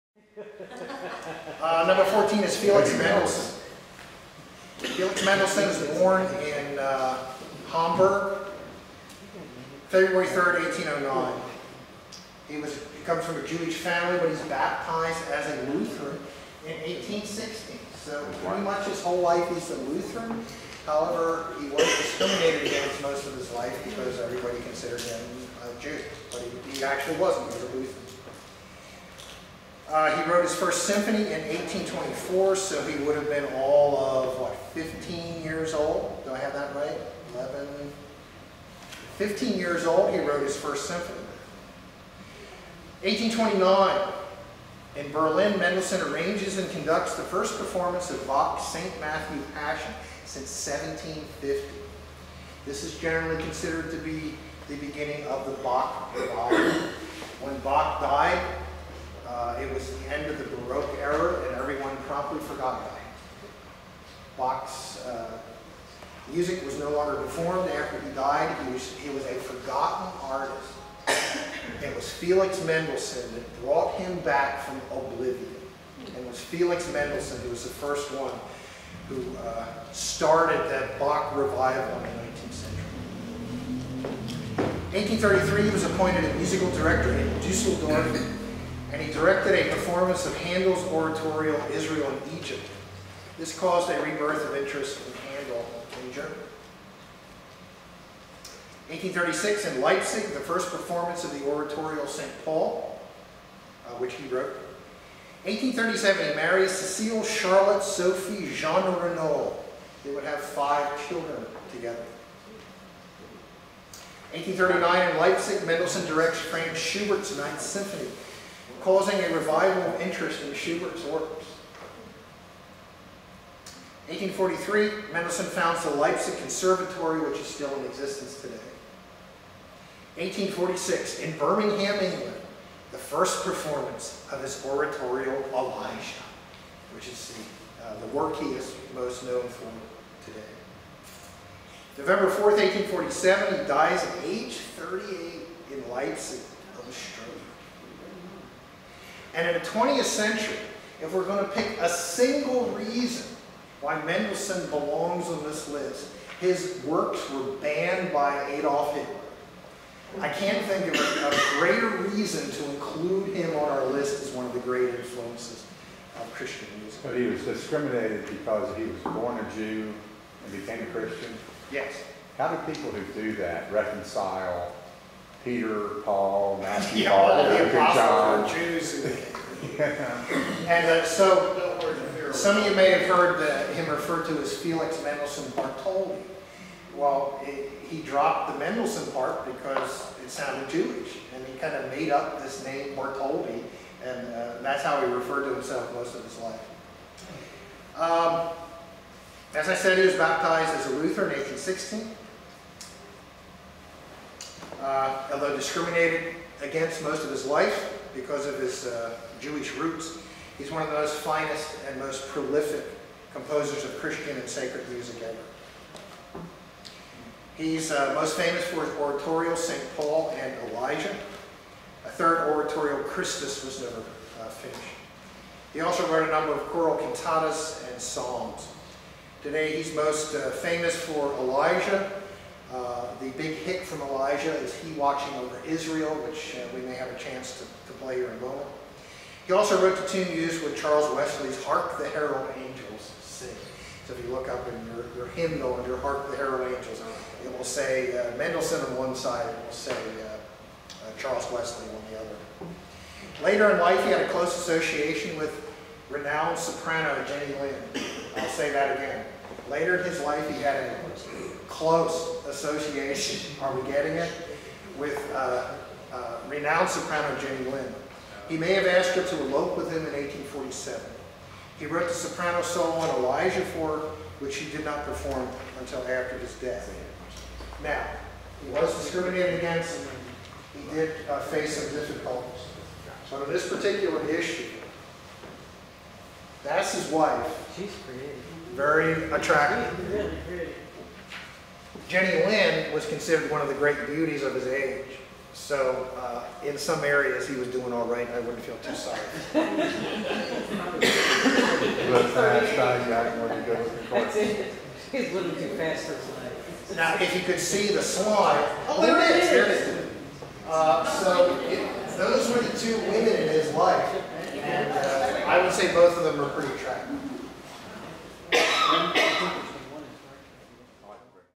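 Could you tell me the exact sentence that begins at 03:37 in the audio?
He's uh, most famous for his oratorial St.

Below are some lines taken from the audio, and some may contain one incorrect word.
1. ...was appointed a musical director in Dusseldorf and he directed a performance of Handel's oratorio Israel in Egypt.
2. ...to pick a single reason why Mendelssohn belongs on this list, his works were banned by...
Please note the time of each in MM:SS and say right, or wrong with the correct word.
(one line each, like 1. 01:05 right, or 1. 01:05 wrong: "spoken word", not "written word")
1. 01:25 right
2. 02:31 right.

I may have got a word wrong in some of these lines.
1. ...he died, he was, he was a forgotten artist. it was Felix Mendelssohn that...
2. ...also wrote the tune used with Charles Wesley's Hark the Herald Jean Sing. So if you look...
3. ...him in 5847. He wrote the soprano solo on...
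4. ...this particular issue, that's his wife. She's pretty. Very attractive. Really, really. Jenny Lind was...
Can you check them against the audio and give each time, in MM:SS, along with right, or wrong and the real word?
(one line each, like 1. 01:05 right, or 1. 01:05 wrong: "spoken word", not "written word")
1. 01:08 right
2. 03:59 wrong: "Angels", not "Jean"
3. 04:29 wrong: "1847", not "5847"
4. 04:43 right.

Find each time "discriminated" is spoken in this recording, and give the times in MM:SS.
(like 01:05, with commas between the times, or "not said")
00:21, 02:47, 03:25, 04:39.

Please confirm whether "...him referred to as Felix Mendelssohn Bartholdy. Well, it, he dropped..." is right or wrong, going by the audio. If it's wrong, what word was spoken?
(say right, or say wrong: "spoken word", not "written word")
right.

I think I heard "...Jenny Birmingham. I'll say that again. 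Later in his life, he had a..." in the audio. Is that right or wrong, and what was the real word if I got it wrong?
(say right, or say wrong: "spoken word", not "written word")
wrong: "Lind", not "Birmingham".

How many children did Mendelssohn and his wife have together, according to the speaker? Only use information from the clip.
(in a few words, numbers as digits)
5.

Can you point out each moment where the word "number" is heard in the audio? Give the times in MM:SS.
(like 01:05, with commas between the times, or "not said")
00:01, 03:46.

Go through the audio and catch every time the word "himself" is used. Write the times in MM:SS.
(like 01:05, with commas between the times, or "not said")
03:15.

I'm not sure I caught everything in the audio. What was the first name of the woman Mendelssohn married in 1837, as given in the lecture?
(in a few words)
Cecile.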